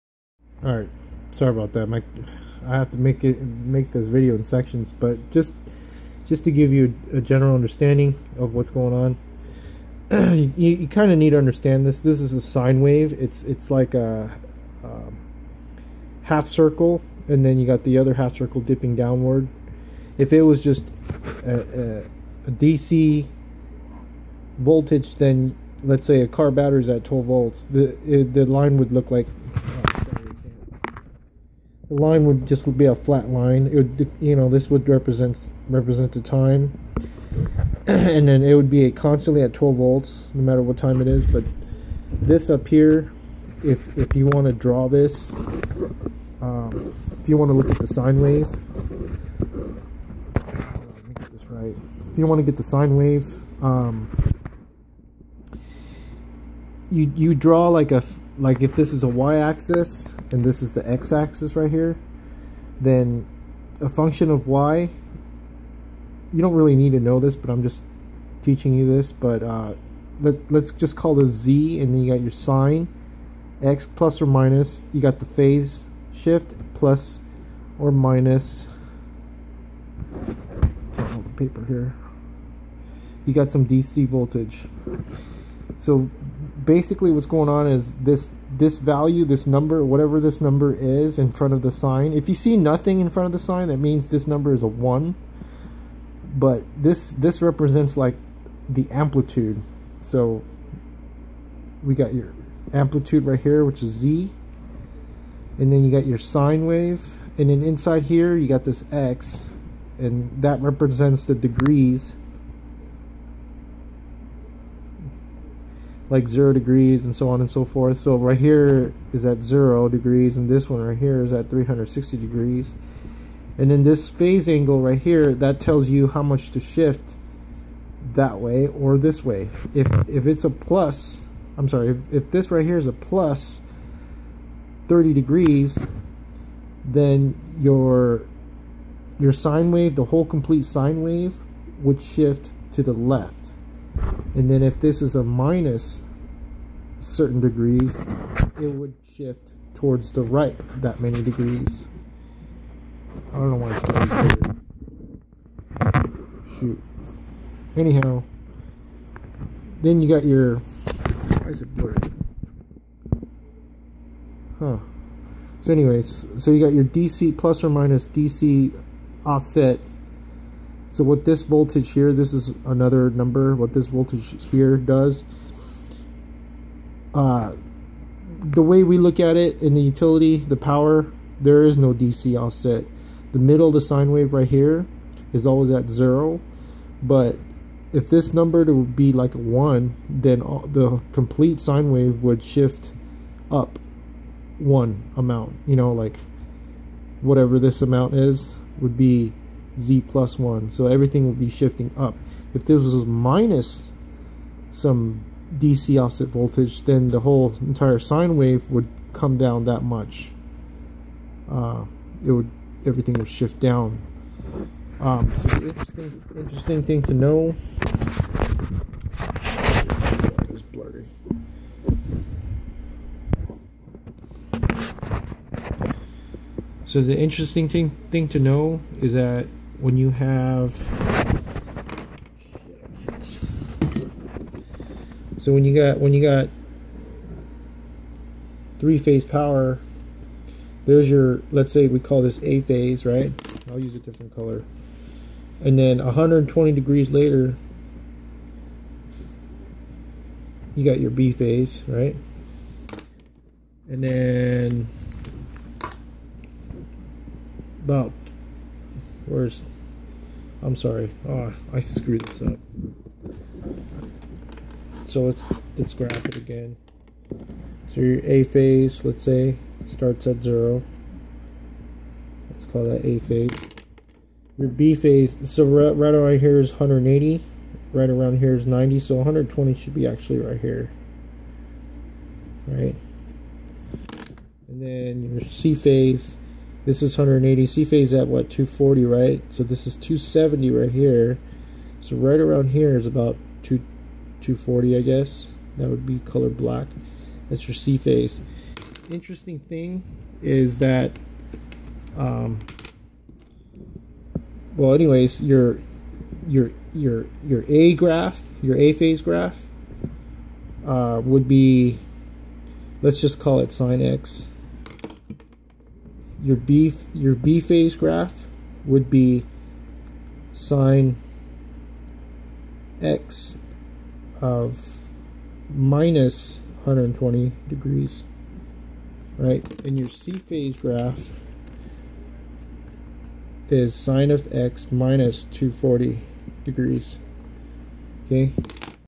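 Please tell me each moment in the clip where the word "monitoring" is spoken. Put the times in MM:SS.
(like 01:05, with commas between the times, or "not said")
not said.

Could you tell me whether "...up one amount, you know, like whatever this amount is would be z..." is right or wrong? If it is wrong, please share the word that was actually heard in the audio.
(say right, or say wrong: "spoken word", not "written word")
right.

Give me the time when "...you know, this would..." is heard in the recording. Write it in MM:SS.
00:34.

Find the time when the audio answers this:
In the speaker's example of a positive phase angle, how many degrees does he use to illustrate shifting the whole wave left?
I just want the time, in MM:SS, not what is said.
02:12.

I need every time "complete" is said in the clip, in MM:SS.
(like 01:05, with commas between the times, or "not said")
02:20, 03:11.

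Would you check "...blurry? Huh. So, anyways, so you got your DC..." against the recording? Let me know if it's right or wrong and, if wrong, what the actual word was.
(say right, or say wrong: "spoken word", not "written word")
right.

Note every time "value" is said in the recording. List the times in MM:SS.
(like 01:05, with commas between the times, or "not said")
01:28.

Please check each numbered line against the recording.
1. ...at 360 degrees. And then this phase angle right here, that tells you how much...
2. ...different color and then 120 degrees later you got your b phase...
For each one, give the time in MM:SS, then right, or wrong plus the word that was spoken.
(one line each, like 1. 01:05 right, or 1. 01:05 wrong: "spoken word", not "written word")
1. 02:01 right
2. 04:03 right.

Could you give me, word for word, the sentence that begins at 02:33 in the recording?
I don't know why it's getting weird.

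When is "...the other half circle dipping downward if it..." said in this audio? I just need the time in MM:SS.
00:17.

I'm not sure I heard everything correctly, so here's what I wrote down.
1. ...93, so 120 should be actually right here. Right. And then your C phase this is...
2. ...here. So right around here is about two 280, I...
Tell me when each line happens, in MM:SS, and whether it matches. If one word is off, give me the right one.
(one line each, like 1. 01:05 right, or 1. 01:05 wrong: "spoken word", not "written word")
1. 04:38 wrong: "90", not "93"
2. 04:50 wrong: "240", not "280".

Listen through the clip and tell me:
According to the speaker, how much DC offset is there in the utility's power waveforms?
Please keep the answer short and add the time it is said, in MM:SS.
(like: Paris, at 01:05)
No DC offset, at 03:01.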